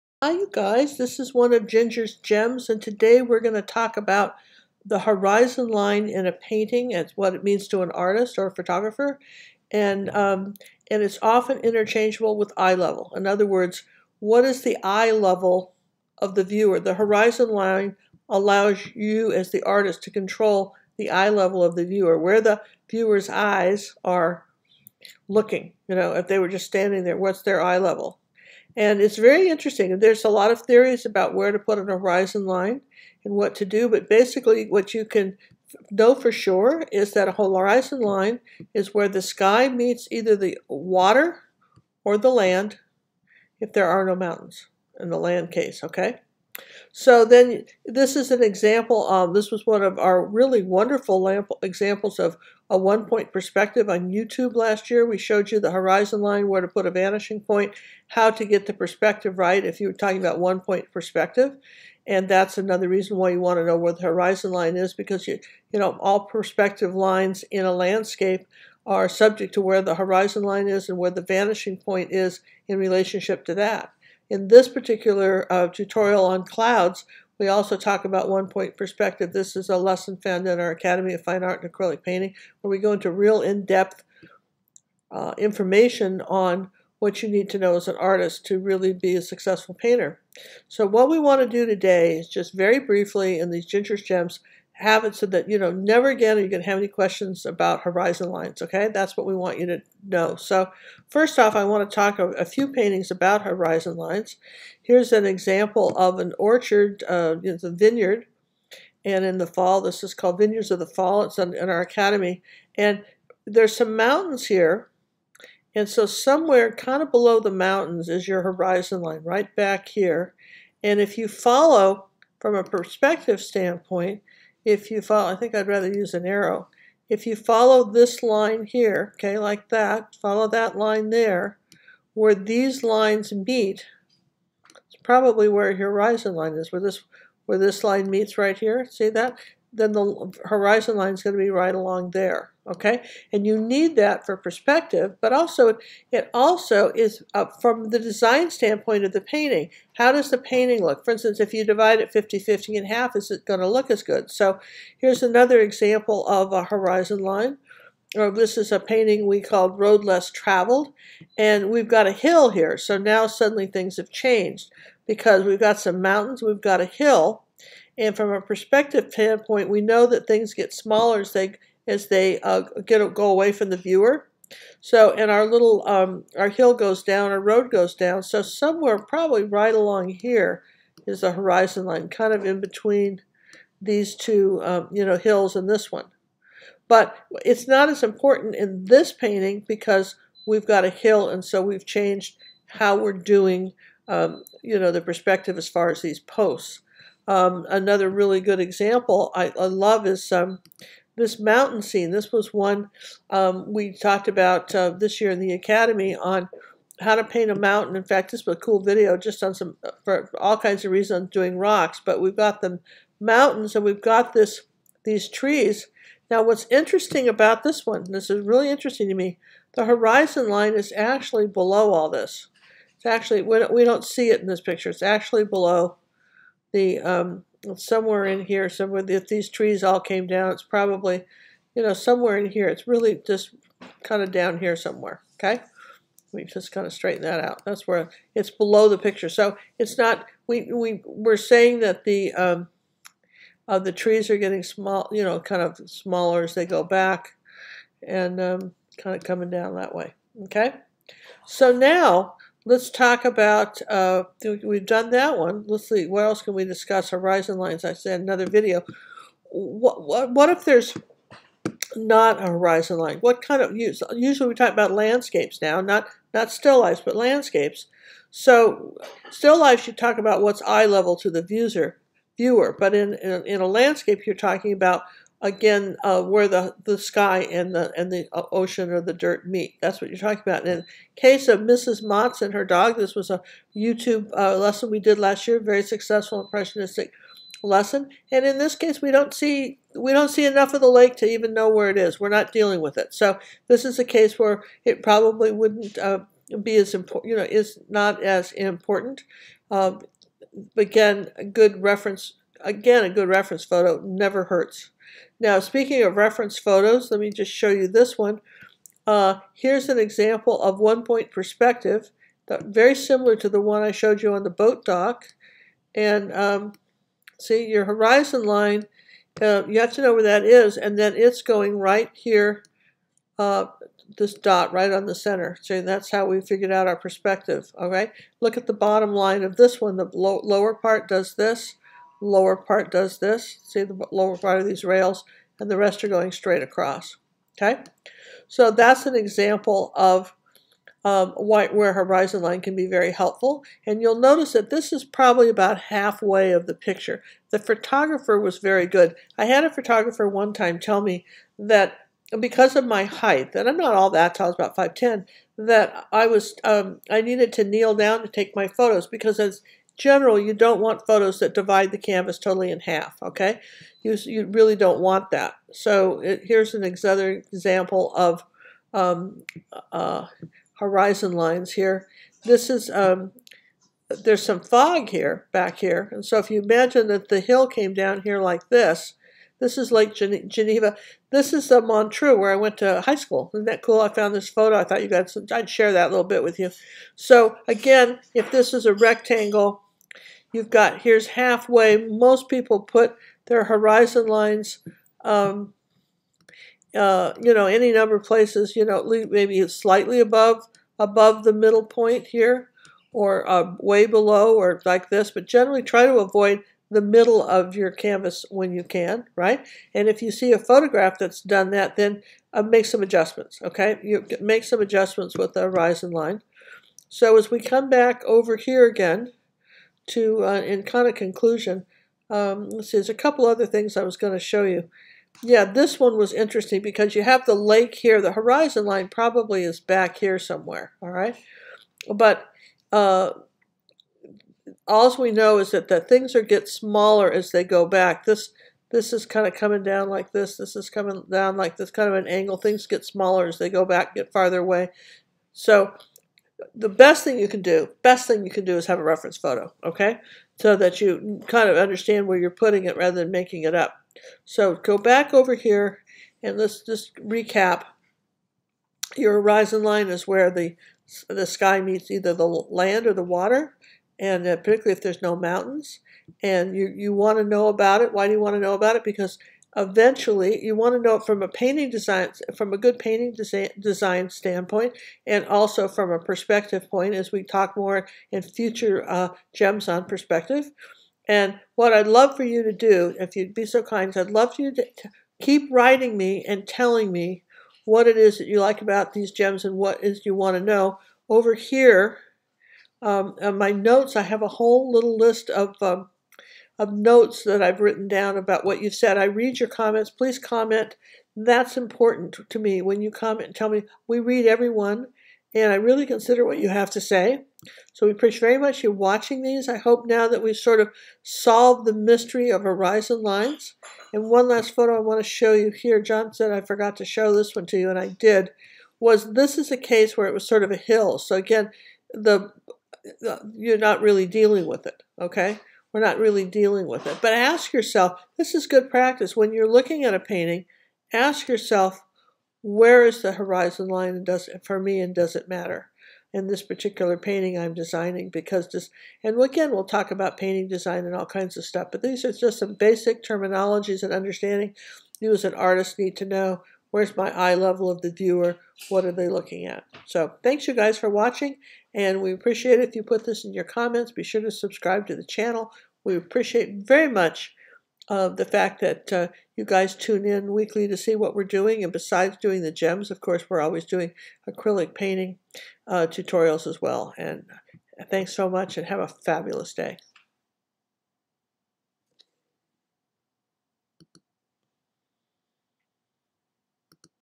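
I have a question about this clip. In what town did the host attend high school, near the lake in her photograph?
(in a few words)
Montreux.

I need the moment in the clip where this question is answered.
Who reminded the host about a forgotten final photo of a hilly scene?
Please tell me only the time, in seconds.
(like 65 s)
516 s.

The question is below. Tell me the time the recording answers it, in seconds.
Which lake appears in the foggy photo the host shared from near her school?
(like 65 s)
379 s.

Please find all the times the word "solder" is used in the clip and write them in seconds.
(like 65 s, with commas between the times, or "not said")
not said.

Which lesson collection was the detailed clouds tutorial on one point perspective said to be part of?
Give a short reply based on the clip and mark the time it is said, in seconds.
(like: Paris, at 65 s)
Academy of Fine Art and Acrylic Painting, at 80 s.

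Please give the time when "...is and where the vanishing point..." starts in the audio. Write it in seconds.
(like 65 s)
70 s.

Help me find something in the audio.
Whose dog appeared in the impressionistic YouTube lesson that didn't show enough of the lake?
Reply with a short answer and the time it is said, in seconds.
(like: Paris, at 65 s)
Mrs. Motz, at 281 s.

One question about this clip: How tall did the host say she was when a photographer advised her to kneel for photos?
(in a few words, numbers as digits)
5'10".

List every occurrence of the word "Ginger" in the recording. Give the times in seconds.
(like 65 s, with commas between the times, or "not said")
1 s, 93 s.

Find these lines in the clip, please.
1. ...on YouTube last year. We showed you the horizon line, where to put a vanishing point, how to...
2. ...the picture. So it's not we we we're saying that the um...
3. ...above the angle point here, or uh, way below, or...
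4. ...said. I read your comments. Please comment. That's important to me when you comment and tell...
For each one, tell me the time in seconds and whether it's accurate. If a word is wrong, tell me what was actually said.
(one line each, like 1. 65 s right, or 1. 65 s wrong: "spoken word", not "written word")
1. 53 s right
2. 238 s right
3. 400 s wrong: "middle", not "angle"
4. 498 s right.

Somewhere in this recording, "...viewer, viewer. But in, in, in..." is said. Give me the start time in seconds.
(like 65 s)
271 s.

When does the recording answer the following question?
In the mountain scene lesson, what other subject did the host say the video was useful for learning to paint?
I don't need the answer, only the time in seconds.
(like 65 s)
211 s.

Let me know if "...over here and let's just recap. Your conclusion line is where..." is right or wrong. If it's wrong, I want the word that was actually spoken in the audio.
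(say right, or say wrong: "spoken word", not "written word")
wrong: "horizon", not "conclusion".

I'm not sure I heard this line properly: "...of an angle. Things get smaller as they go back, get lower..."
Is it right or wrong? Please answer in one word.
wrong.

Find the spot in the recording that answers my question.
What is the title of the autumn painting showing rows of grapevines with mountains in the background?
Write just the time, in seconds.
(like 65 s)
110 s.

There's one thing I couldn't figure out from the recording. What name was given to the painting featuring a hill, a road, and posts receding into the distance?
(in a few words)
Road Less Traveled.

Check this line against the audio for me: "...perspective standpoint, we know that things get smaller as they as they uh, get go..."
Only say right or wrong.
right.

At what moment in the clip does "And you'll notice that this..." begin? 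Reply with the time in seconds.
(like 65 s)
343 s.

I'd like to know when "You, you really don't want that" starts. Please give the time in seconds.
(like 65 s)
364 s.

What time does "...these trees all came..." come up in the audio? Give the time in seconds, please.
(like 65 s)
229 s.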